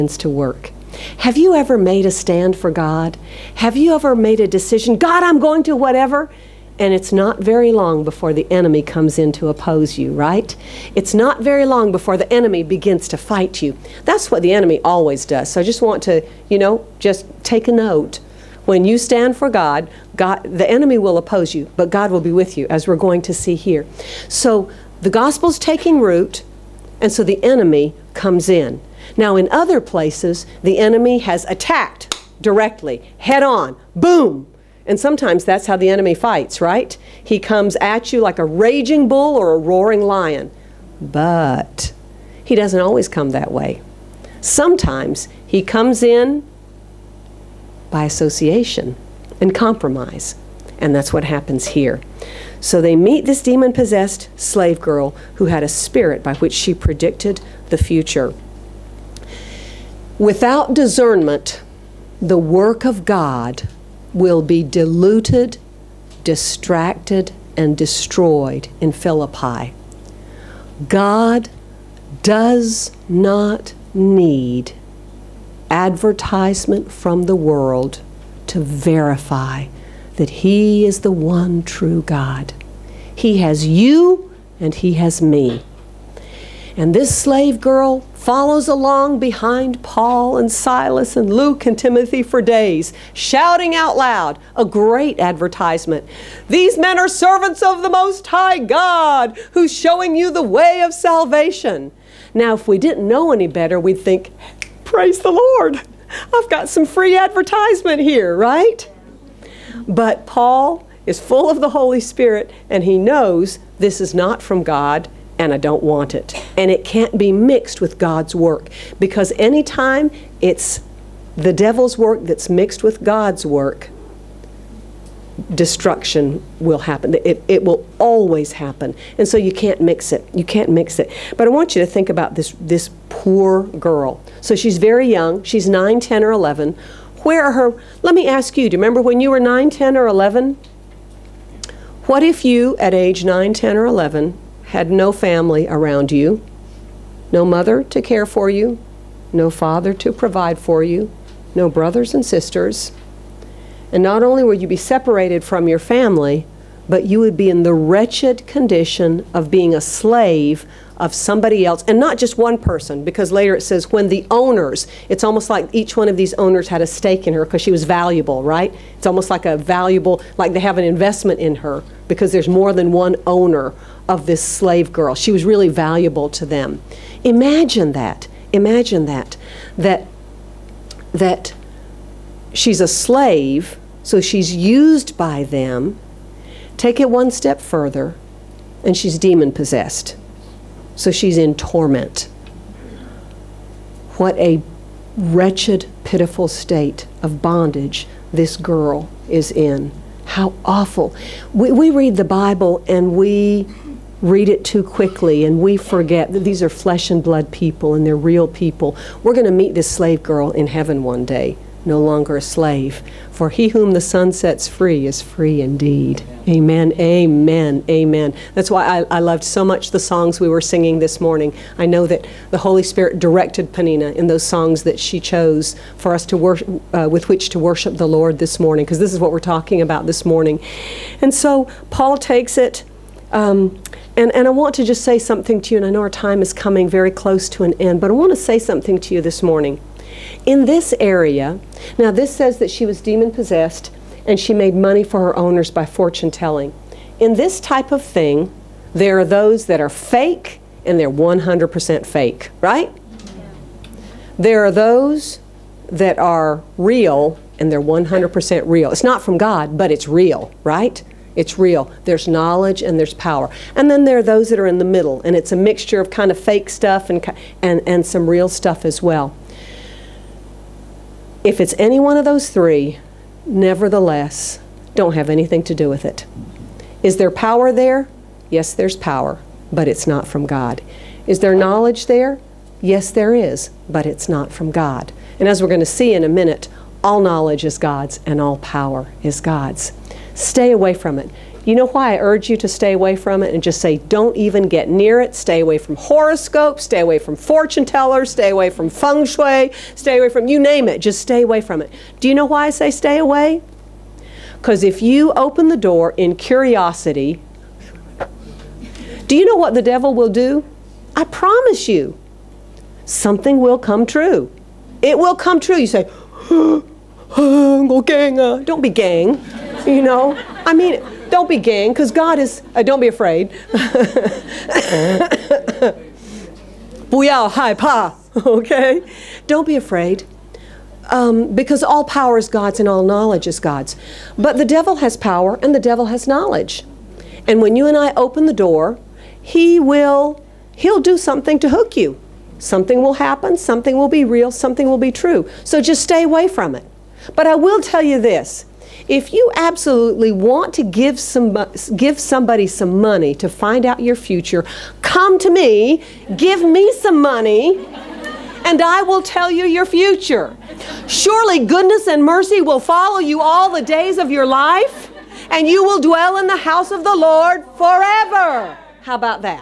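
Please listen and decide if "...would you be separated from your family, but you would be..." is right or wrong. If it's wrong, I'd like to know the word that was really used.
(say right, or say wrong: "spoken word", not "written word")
right.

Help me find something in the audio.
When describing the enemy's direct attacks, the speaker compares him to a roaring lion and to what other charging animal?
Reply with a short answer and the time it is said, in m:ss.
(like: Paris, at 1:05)
a raging bull, at 0:38.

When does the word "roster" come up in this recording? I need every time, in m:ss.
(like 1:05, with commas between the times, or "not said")
not said.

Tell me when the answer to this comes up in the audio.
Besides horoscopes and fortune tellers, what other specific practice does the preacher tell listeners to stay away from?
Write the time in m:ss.
4:58.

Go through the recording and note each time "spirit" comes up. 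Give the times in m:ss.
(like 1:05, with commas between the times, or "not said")
0:55, 1:52, 3:42.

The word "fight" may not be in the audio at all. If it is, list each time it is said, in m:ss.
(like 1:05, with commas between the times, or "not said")
0:13, 0:36.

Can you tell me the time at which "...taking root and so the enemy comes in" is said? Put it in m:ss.
0:25.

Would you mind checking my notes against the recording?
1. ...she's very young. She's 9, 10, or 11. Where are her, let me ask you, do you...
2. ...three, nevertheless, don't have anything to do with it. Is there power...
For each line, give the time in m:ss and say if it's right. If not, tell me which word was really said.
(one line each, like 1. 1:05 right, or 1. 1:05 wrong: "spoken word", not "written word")
1. 2:14 right
2. 4:32 right.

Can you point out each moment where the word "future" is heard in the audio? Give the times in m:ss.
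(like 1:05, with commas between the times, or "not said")
0:57, 5:54, 5:59.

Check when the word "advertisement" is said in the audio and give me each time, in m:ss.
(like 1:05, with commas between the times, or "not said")
1:15, 1:35, 1:47.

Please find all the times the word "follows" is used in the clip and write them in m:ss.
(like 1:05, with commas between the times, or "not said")
1:28, 6:02.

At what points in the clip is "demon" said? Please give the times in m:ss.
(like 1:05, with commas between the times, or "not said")
0:53, 3:09, 4:03.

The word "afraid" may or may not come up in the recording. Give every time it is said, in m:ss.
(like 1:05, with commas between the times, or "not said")
5:23, 5:29.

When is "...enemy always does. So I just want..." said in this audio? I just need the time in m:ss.
0:14.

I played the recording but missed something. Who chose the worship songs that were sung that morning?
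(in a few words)
Panina.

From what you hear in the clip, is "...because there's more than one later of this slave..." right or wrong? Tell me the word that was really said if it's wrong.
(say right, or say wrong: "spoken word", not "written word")
wrong: "owner", not "later".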